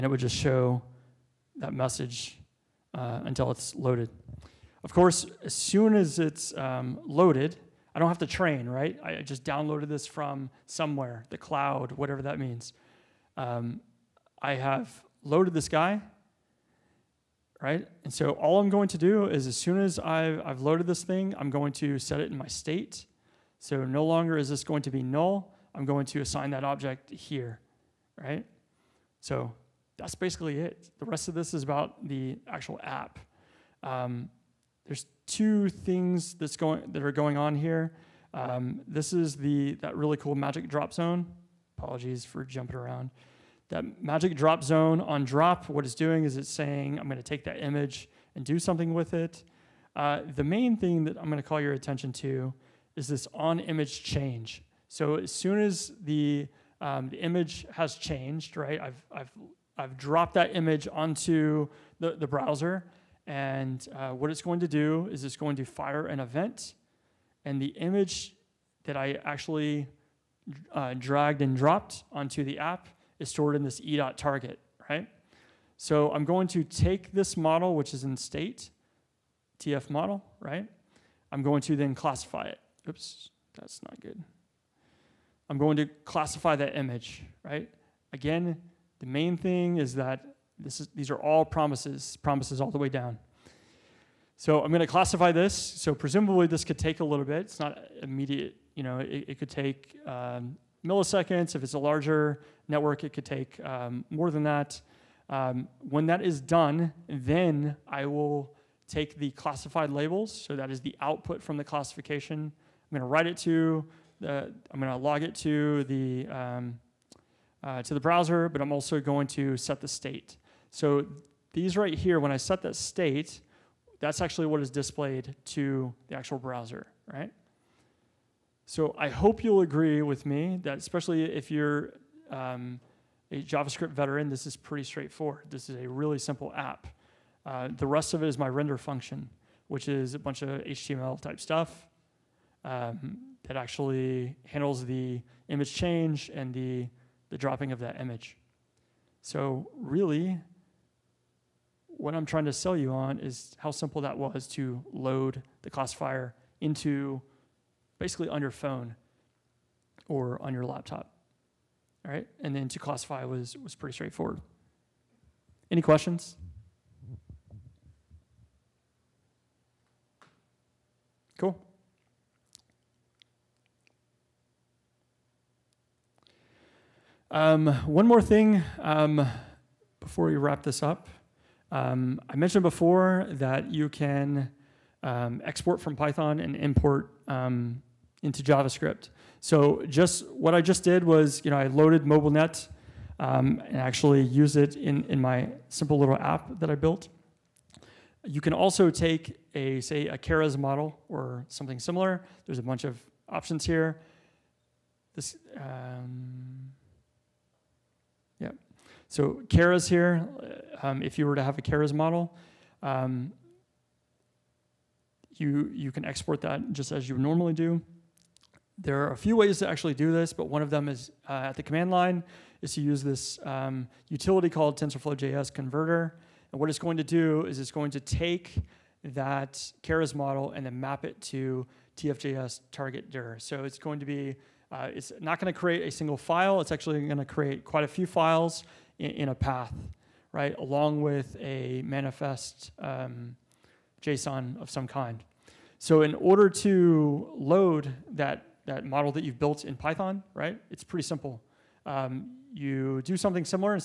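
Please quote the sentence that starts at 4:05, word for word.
So in order to load that, that model that you've built in Python, right, it's pretty simple.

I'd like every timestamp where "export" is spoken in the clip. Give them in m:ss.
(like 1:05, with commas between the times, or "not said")
3:05, 3:36.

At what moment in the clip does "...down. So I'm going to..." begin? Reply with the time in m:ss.
1:32.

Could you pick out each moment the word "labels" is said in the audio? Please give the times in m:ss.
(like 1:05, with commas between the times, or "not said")
1:49.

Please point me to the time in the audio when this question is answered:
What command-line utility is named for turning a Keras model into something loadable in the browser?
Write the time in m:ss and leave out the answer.
3:44.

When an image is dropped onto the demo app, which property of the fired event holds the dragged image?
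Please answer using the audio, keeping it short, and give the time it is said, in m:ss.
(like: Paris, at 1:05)
e.target, at 1:13.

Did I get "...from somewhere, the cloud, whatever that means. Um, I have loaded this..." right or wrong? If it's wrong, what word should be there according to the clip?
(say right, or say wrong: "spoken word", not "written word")
right.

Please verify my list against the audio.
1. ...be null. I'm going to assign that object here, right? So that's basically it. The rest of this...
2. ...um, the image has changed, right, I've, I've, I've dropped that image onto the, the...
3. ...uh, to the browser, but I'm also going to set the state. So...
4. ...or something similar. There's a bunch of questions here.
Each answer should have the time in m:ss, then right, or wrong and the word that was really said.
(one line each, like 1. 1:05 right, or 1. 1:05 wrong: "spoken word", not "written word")
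1. 0:24 right
2. 0:56 right
3. 1:57 right
4. 3:21 wrong: "options", not "questions".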